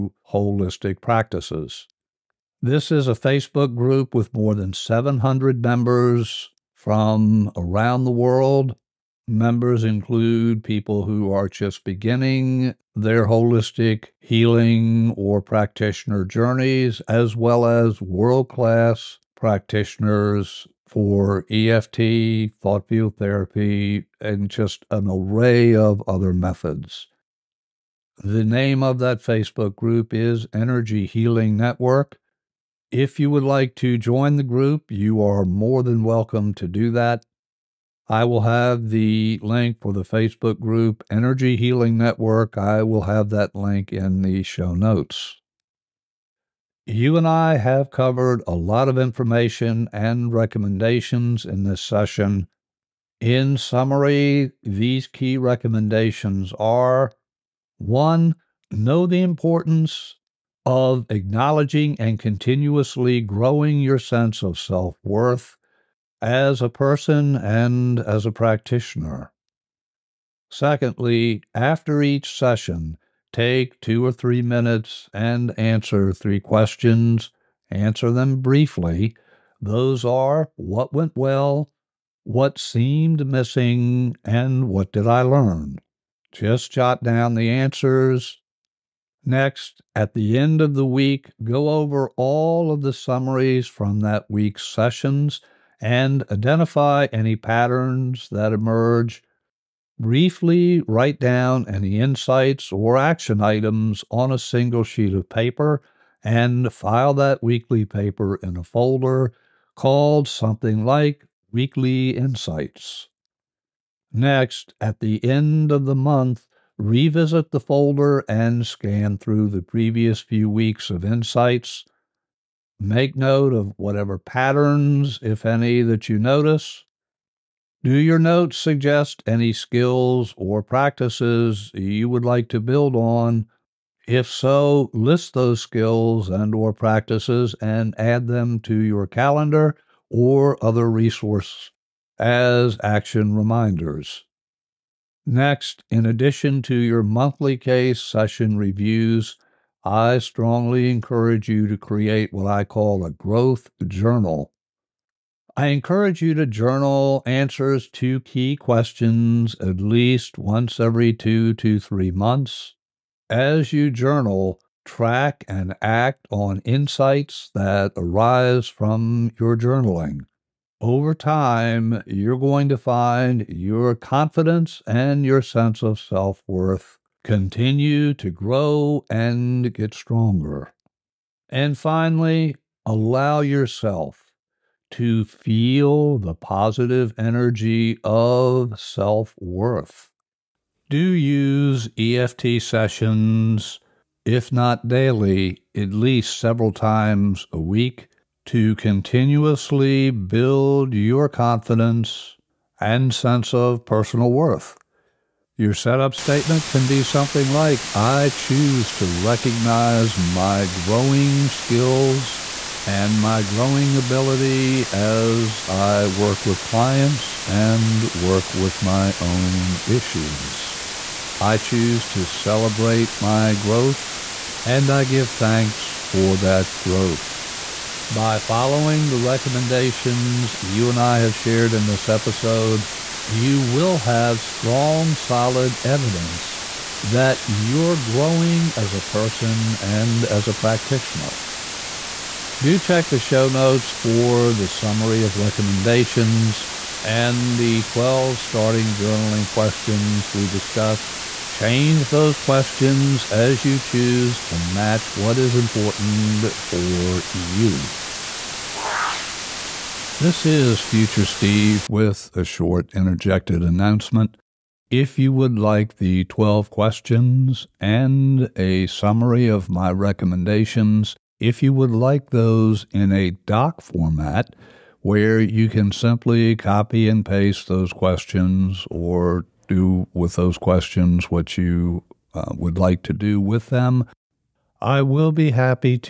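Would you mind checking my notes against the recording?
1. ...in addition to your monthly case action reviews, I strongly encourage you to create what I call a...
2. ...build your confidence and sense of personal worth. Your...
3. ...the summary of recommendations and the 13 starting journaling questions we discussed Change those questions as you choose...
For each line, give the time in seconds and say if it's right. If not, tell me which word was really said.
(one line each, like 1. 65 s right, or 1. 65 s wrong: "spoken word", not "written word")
1. 145 s wrong: "session", not "action"
2. 200 s right
3. 244 s wrong: "12", not "13".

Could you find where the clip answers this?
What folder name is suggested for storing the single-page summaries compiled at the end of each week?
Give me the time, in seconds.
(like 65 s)
111 s.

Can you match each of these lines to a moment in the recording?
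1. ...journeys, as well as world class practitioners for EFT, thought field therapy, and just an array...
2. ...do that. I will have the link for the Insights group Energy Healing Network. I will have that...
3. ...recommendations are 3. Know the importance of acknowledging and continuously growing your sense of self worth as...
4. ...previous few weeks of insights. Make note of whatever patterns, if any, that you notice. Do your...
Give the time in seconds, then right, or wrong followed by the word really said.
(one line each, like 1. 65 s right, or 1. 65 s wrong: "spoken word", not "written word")
1. 16 s right
2. 36 s wrong: "Facebook", not "Insights"
3. 55 s wrong: "1", not "3"
4. 119 s right.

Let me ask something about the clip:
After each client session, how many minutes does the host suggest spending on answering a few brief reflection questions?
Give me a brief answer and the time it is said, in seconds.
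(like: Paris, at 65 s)
2 or 3 minutes, at 73 s.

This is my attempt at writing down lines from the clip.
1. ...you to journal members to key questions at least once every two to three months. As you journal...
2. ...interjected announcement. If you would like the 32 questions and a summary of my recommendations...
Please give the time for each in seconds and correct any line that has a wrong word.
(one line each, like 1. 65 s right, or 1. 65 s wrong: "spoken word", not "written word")
1. 156 s wrong: "answers", not "members"
2. 262 s wrong: "12", not "32".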